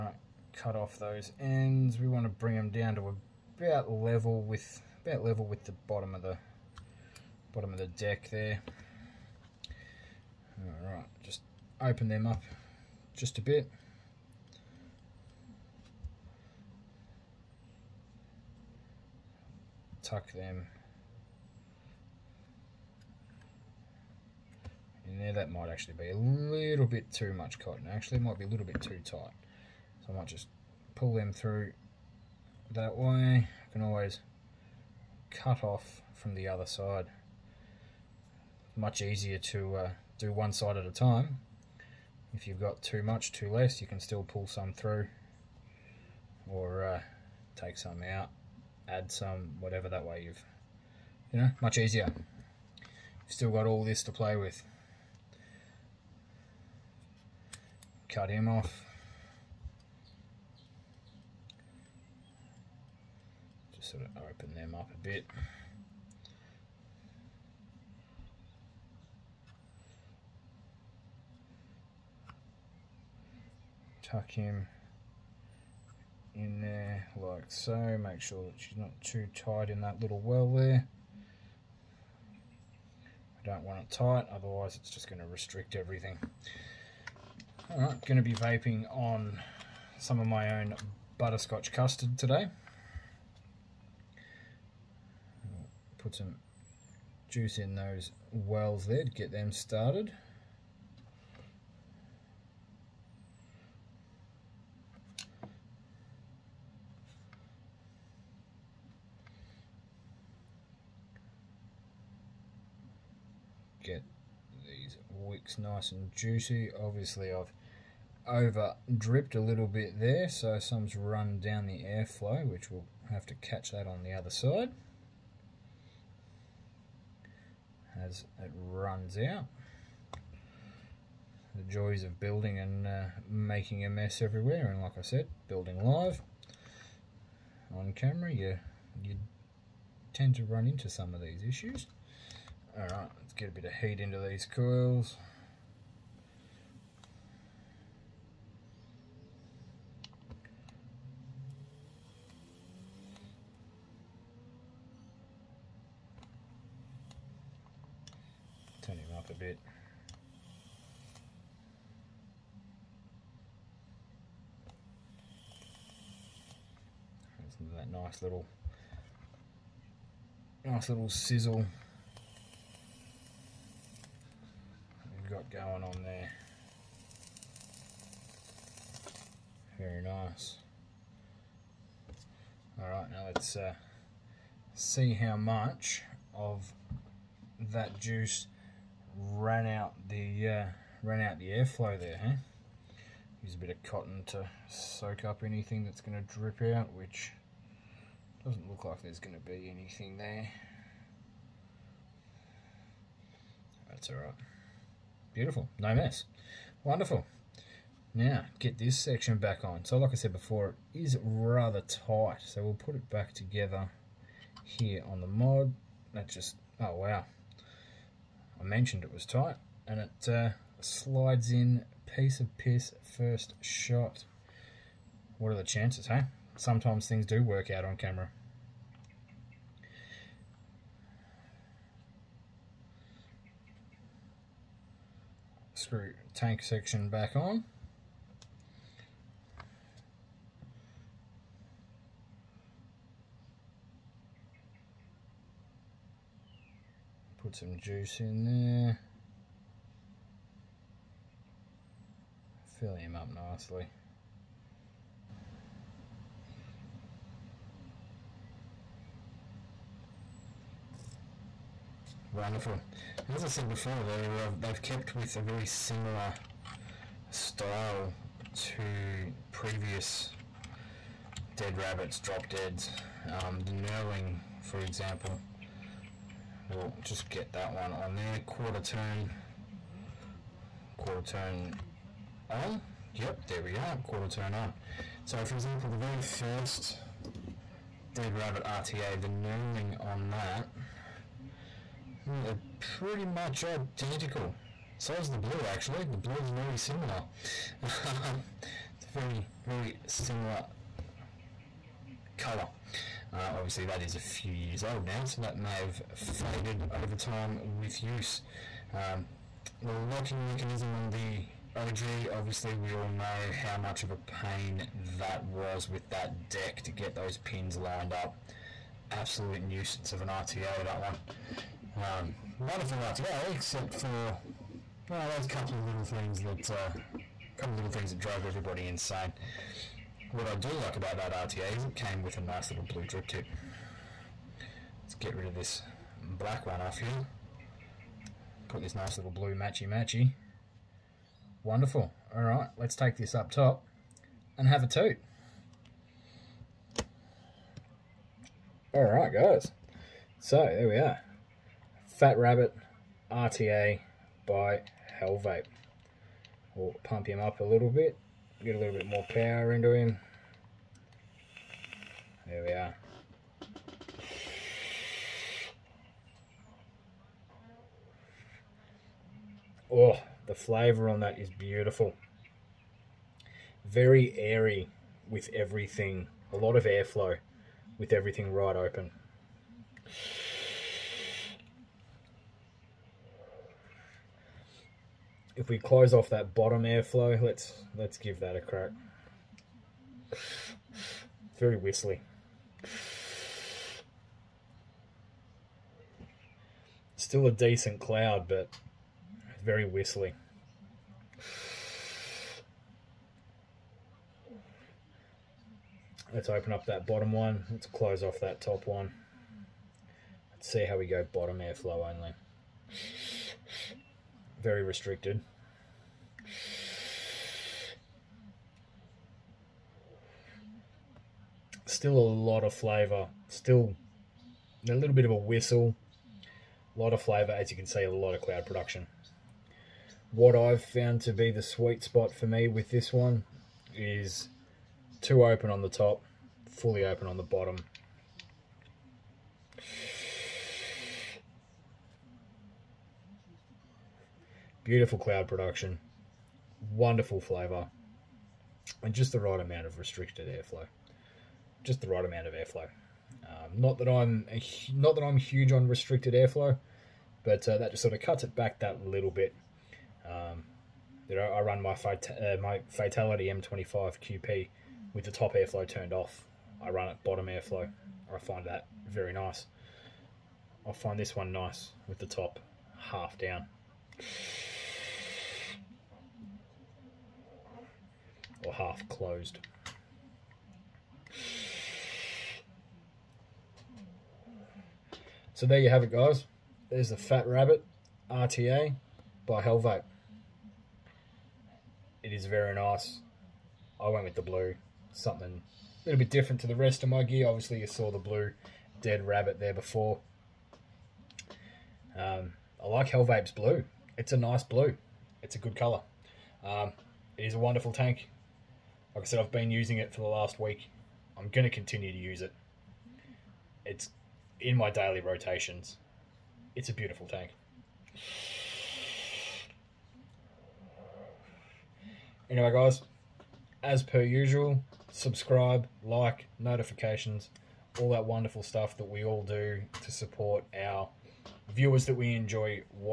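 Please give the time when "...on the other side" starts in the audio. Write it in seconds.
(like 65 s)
123 s.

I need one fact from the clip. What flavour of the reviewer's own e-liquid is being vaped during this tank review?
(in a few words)
Butterscotch custard.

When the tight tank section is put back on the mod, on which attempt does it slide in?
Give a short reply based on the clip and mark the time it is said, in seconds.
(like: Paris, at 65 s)
First shot, at 223 s.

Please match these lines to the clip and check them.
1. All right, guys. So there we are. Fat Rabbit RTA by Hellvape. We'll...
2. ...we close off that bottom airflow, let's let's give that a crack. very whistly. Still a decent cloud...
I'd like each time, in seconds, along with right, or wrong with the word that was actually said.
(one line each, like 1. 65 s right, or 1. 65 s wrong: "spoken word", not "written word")
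1. 348 s right
2. 385 s right.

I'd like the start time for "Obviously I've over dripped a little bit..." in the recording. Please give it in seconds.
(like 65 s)
116 s.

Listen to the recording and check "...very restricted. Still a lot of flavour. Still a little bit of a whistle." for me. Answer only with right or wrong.
right.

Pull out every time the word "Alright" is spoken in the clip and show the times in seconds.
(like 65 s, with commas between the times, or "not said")
10 s, 87 s.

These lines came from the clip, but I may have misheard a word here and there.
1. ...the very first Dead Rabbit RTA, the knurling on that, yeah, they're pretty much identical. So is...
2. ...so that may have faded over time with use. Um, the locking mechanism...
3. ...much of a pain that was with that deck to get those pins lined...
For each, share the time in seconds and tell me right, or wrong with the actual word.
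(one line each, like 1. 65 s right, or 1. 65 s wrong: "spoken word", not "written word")
1. 285 s right
2. 305 s right
3. 313 s right.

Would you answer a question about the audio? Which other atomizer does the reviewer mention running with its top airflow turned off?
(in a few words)
Fatality M25 QP.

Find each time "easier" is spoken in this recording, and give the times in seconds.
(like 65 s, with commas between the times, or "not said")
38 s, 51 s.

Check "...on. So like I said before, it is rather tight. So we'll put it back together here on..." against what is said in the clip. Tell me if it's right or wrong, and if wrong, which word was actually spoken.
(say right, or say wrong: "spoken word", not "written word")
right.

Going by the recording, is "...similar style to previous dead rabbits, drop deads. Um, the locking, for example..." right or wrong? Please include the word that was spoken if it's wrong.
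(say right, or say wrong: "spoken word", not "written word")
wrong: "knurling", not "locking".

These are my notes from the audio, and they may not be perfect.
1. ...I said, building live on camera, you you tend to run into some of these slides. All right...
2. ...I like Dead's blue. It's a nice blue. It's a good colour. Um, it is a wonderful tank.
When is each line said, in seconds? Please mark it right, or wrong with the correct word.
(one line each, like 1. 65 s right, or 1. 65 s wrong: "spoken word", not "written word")
1. 134 s wrong: "issues", not "slides"
2. 502 s wrong: "Hellvape", not "Dead".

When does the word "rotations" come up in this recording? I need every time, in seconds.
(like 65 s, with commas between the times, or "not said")
515 s.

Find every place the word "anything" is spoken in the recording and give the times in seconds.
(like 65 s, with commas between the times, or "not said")
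195 s, 199 s.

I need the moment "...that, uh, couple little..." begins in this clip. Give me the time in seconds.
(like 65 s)
326 s.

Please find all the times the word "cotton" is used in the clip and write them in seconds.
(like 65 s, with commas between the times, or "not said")
27 s, 193 s.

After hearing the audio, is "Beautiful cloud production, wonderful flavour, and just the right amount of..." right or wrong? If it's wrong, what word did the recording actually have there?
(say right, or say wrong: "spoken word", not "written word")
right.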